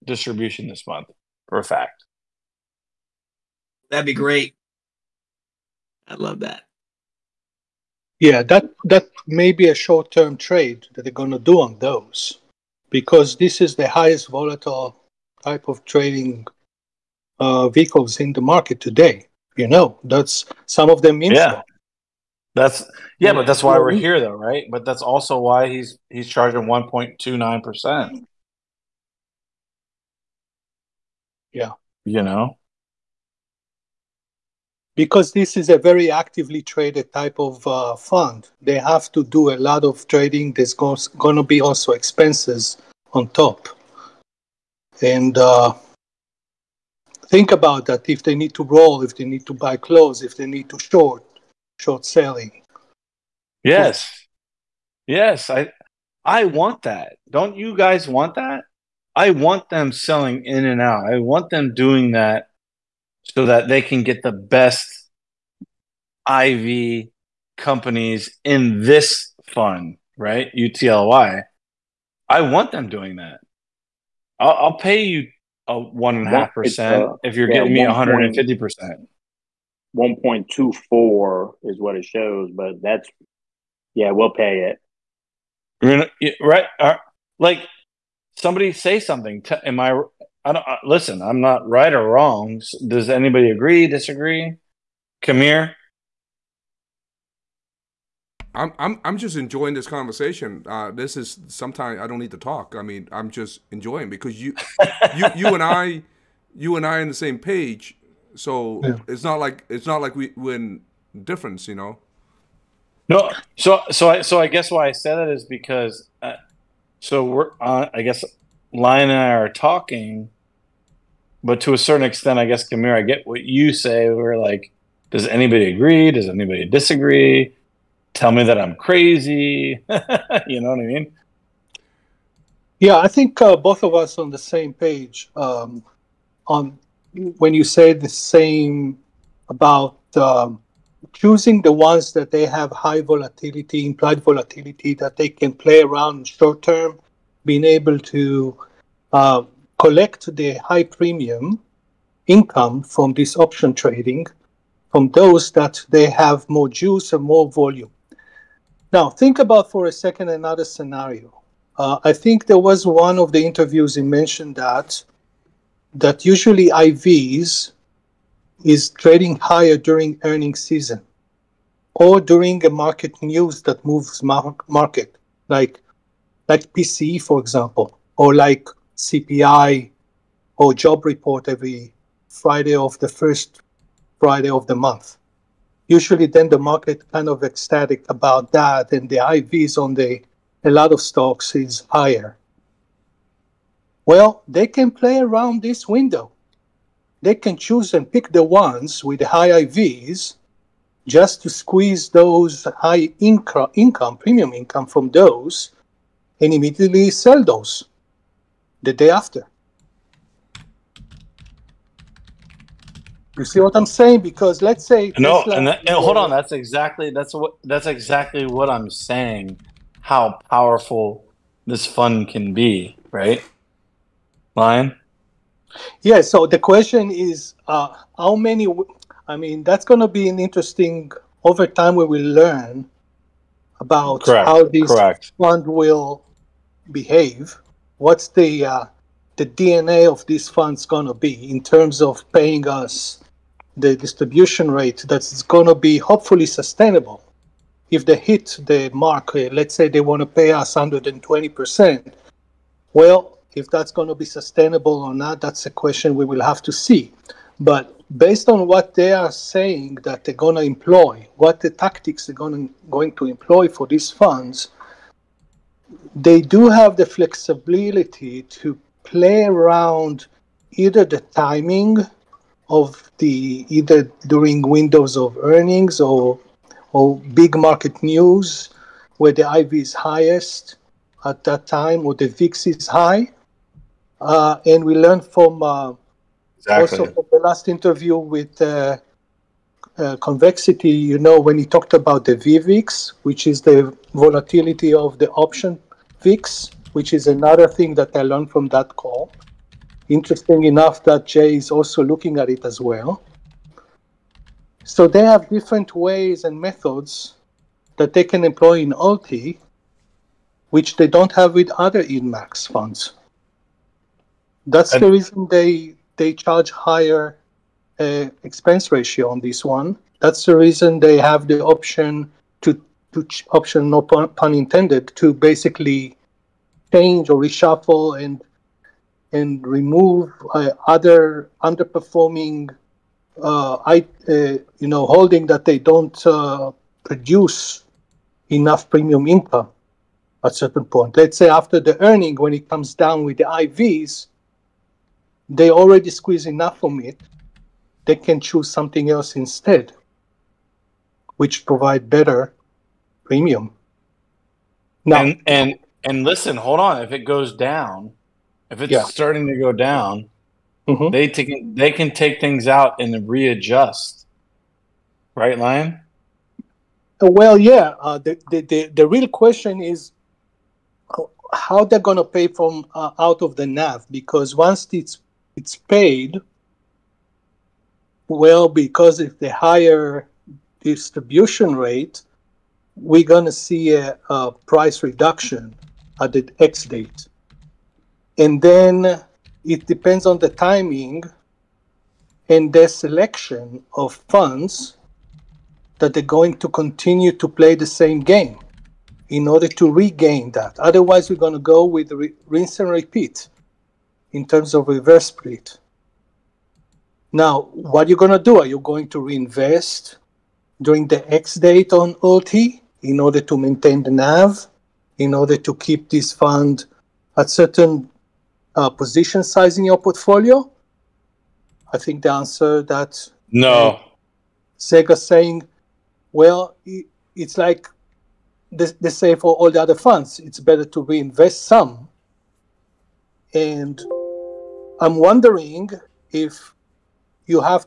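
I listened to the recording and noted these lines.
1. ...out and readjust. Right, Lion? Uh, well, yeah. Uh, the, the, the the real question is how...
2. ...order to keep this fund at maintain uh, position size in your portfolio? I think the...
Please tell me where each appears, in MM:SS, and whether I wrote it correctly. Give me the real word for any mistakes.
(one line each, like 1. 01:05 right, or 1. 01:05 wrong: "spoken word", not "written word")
1. 06:02 right
2. 06:55 wrong: "certain", not "maintain".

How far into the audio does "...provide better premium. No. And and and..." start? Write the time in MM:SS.
05:51.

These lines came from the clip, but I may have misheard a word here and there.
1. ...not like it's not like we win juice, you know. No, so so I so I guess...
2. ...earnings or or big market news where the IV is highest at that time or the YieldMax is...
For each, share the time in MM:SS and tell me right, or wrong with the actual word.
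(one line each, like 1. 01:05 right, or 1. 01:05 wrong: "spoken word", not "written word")
1. 01:49 wrong: "difference", not "juice"
2. 04:35 wrong: "VIX", not "YieldMax".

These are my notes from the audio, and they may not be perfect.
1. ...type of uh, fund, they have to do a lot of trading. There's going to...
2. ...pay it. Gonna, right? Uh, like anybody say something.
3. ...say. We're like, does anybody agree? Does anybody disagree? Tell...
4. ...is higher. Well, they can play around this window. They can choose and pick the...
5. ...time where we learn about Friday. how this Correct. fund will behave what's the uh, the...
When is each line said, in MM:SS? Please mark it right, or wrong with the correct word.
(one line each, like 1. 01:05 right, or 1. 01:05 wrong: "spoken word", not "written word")
1. 00:37 right
2. 01:24 wrong: "somebody", not "anybody"
3. 02:03 right
4. 03:11 right
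5. 03:51 wrong: "Correct", not "Friday".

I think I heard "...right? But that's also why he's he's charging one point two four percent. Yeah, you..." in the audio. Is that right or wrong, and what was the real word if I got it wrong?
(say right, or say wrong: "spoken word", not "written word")
wrong: "nine", not "four".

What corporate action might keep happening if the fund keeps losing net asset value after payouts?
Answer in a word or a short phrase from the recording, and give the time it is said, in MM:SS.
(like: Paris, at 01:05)
reverse split, at 06:44.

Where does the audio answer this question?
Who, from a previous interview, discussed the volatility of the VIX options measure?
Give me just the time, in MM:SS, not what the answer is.
04:50.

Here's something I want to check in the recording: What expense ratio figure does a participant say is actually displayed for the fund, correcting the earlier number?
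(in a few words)
1.24.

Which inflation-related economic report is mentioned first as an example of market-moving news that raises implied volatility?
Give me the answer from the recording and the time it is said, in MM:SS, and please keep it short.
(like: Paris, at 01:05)
PCE, at 02:56.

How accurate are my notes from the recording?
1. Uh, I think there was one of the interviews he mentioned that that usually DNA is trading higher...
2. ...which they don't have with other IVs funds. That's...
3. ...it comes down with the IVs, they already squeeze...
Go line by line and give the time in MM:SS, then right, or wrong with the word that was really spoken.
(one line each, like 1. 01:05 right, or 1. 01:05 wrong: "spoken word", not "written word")
1. 02:41 wrong: "IVs", not "DNA"
2. 05:10 wrong: "YieldMax", not "IVs"
3. 05:42 right.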